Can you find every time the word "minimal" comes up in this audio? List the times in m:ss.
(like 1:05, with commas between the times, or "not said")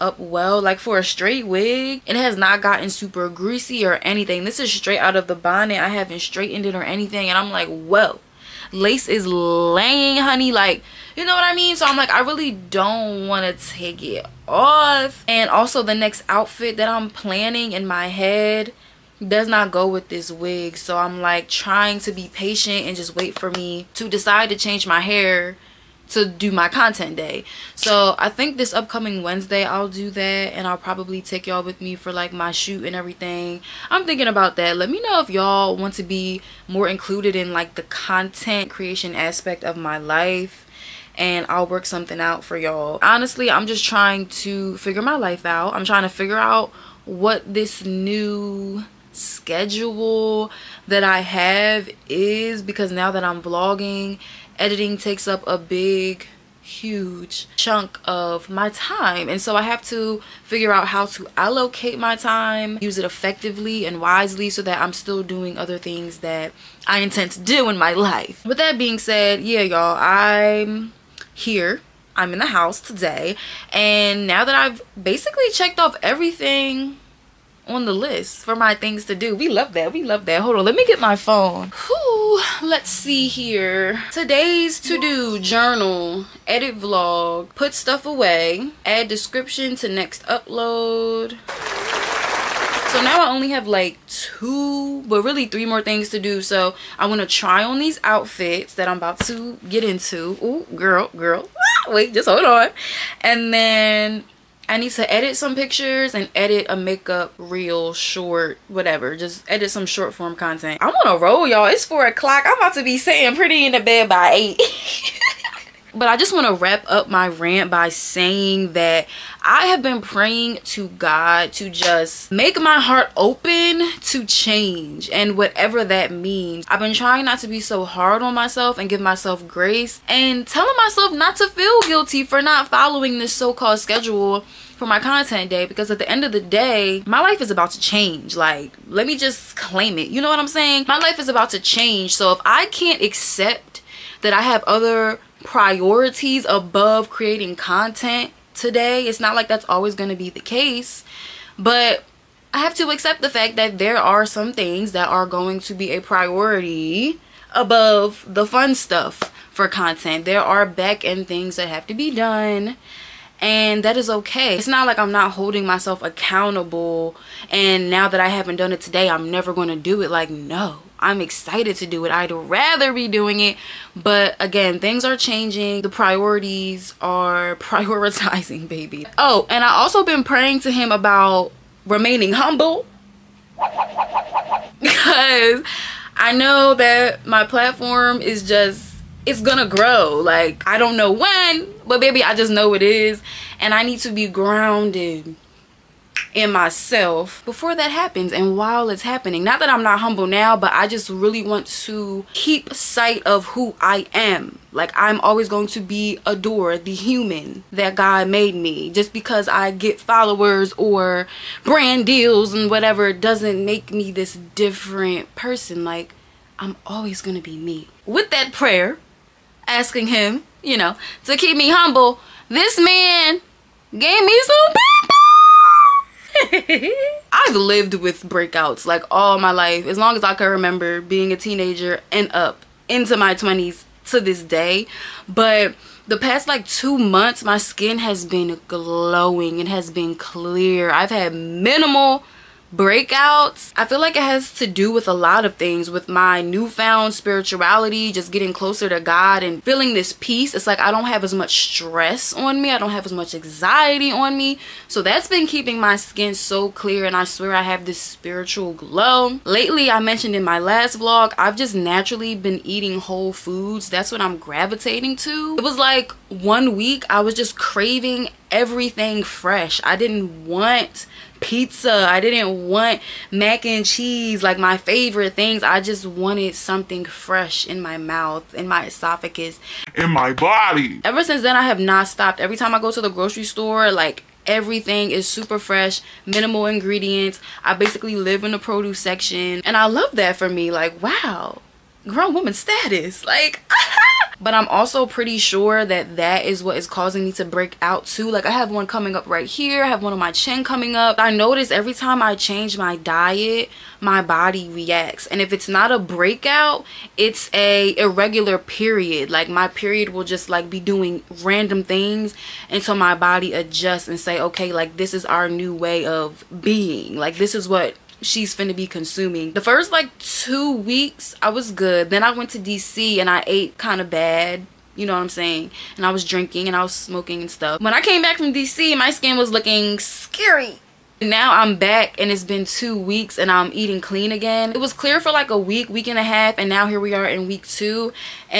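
4:01, 4:46.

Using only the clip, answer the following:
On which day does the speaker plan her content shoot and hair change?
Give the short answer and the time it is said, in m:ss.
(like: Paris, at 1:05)
Wednesday, at 0:29.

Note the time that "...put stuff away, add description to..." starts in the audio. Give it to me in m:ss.
1:27.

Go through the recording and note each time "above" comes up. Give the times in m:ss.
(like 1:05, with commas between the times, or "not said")
2:26, 2:37.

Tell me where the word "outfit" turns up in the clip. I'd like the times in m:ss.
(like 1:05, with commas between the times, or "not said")
0:16, 1:38.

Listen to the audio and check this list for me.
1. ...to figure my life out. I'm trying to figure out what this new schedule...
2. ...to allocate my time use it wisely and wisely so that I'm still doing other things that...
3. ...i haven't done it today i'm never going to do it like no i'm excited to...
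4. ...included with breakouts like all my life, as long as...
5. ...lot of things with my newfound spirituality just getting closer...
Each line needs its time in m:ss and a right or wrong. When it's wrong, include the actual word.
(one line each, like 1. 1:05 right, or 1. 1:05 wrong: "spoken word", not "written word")
1. 0:44 right
2. 1:01 wrong: "effectively", not "wisely"
3. 2:48 right
4. 3:47 wrong: "lived", not "included"
5. 4:05 right.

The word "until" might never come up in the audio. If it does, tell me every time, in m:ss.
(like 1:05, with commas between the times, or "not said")
5:12.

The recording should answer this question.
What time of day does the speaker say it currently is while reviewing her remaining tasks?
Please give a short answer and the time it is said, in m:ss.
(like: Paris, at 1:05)
4 o'clock, at 1:51.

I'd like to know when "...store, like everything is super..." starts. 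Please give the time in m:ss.
4:43.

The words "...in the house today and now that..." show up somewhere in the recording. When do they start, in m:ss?
1:12.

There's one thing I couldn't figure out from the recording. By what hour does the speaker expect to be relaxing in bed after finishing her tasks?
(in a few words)
8.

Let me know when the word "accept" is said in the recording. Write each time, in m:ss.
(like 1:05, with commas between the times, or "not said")
2:23, 2:32.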